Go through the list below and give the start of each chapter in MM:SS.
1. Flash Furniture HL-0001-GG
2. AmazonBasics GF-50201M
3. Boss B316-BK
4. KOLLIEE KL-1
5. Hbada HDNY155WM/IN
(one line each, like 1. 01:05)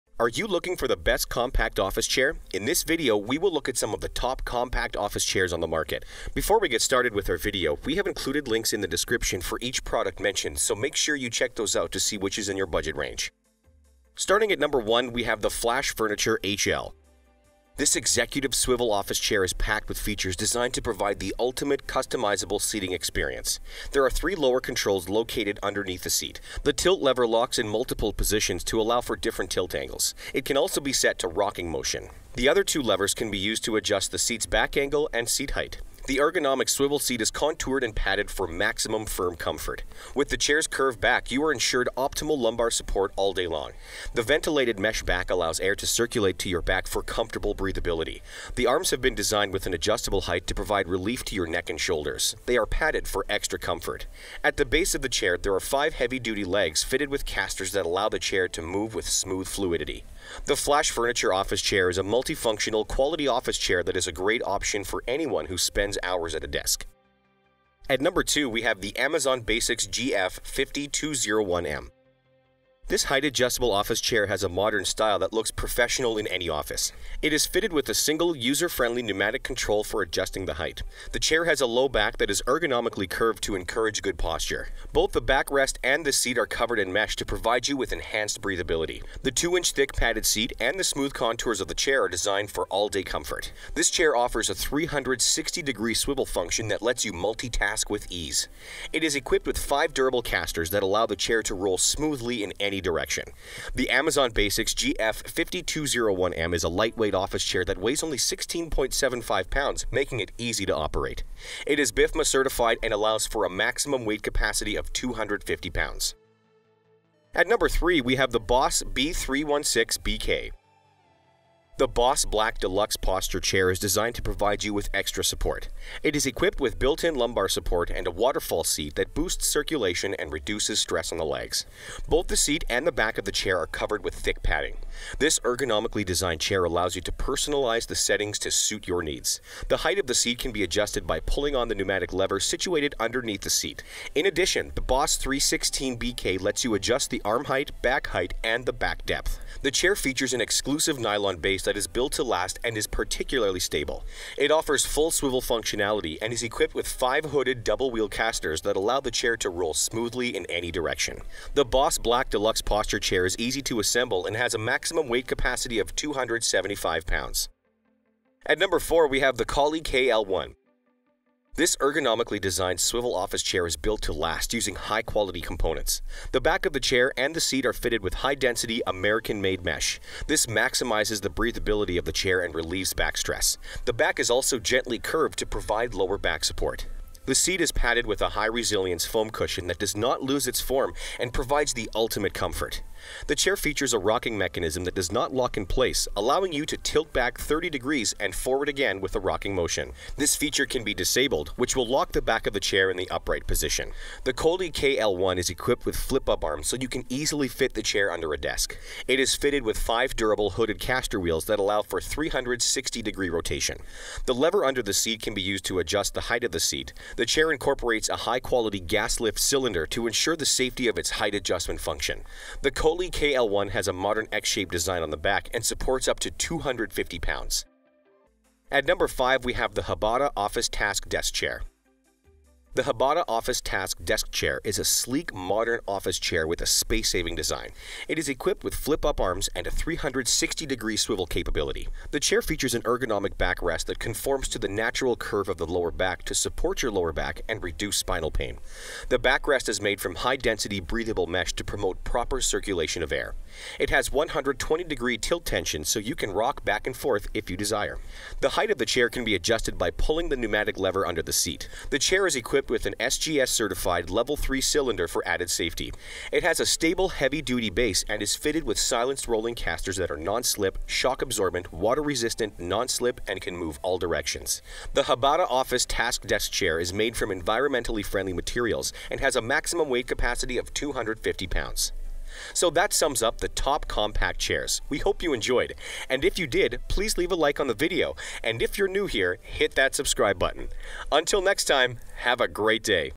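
1. 00:14
2. 01:07
3. 01:58
4. 02:47
5. 03:49.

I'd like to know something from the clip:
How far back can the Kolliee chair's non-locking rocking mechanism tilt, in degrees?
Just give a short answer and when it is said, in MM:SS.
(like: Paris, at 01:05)
30 degrees, at 03:17.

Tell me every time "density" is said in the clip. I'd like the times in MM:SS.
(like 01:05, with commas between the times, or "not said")
02:58, 04:10.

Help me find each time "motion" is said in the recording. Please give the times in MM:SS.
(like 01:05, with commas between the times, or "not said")
00:31, 03:19.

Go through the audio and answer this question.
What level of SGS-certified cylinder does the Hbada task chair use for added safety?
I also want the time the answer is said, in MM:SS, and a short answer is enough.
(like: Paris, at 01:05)
Level 3, at 04:24.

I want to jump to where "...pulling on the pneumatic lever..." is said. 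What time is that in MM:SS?
02:21.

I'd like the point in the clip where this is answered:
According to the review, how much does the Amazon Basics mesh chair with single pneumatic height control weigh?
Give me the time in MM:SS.
01:48.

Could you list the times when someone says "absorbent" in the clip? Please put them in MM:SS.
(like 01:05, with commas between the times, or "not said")
04:30.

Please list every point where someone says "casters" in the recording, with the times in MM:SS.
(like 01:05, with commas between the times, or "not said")
00:57, 01:40, 02:38, 03:30, 04:29.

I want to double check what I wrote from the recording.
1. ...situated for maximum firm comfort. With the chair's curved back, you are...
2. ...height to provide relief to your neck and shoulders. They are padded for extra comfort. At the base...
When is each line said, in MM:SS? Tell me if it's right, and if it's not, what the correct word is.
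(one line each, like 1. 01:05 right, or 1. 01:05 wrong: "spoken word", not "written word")
1. 00:37 wrong: "padded", not "situated"
2. 00:50 right.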